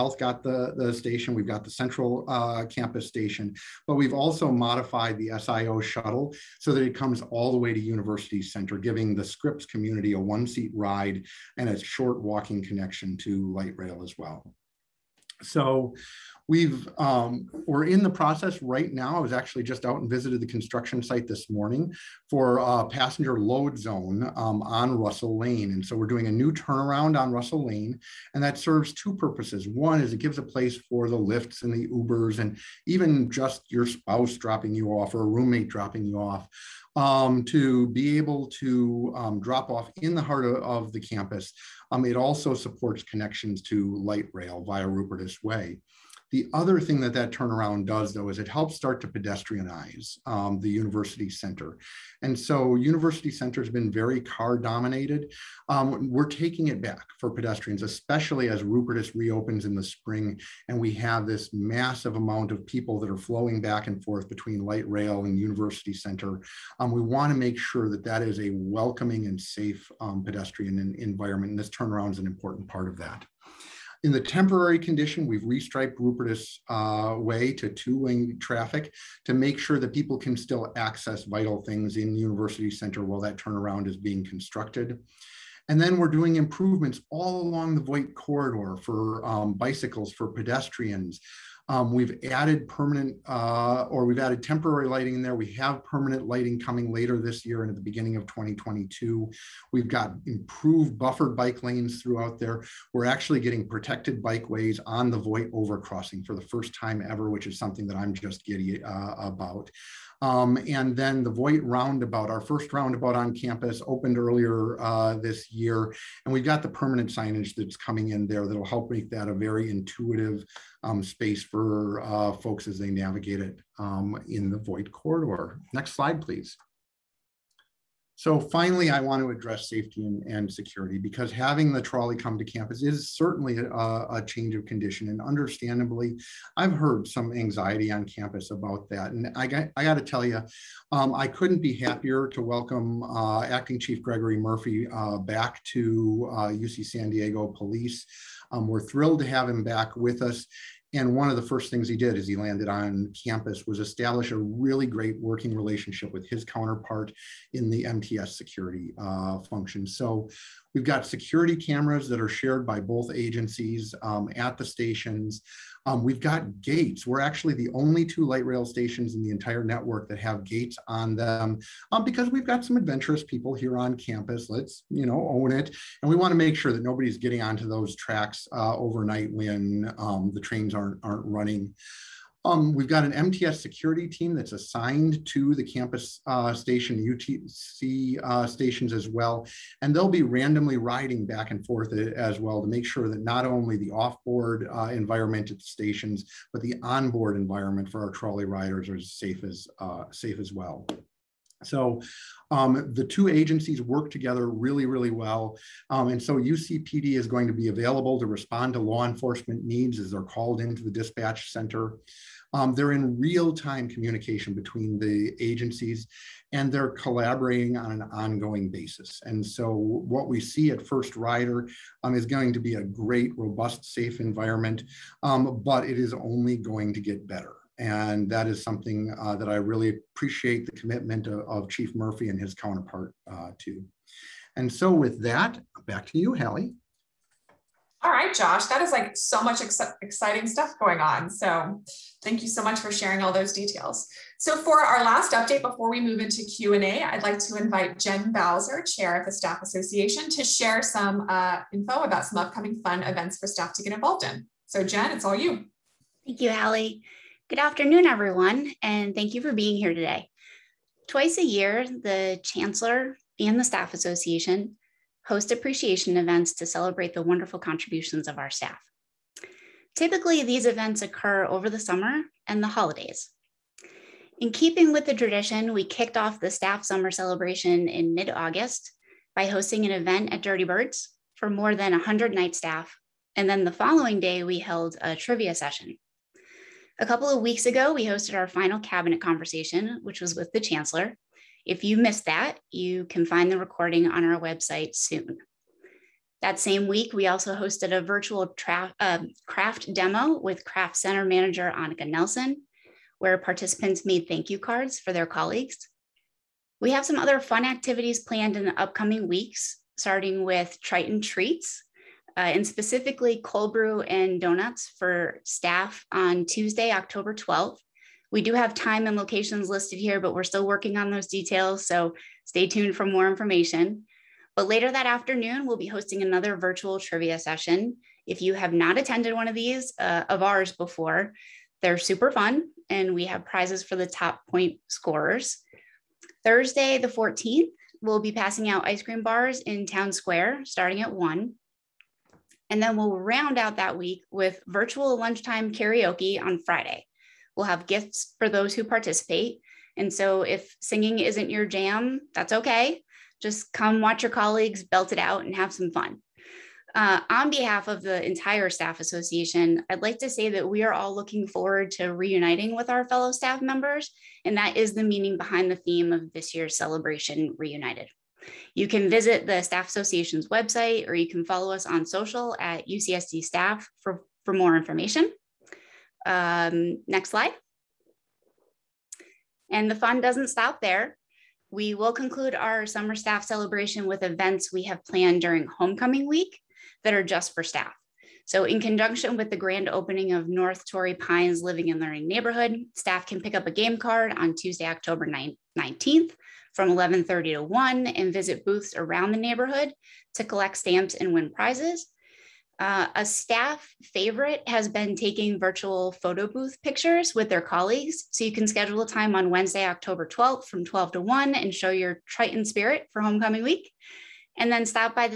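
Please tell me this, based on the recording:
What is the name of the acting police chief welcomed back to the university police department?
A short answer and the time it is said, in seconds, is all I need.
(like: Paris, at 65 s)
Gregory Murphy, at 144 s.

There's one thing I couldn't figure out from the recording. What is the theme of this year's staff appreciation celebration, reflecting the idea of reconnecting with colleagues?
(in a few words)
Reunited.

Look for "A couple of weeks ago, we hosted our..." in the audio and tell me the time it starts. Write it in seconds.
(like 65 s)
287 s.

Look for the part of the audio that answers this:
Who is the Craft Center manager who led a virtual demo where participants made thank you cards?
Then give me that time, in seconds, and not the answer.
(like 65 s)
301 s.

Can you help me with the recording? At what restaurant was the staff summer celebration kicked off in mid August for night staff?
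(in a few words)
Dirty Birds.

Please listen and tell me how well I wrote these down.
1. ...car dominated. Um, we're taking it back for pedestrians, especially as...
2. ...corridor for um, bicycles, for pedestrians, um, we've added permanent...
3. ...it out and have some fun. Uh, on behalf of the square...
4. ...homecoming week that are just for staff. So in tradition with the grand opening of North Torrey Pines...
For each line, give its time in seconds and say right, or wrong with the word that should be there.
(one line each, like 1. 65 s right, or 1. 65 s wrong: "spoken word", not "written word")
1. 54 s right
2. 88 s right
3. 355 s wrong: "entire", not "square"
4. 385 s wrong: "conjunction", not "tradition".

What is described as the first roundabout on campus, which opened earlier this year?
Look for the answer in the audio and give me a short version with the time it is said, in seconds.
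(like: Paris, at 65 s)
Voigt Roundabout, at 111 s.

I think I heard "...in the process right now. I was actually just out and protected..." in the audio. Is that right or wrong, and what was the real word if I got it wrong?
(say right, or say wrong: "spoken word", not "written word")
wrong: "visited", not "protected".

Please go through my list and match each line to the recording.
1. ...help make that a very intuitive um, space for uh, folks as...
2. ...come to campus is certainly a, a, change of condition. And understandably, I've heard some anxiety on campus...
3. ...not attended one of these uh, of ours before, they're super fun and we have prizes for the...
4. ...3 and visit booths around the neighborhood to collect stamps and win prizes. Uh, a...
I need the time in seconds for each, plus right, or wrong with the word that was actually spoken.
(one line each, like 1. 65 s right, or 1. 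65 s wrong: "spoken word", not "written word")
1. 118 s right
2. 132 s right
3. 328 s right
4. 397 s wrong: "1", not "3".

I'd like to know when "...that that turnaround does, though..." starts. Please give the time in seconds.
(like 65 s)
47 s.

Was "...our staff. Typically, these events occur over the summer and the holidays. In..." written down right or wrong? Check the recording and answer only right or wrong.
right.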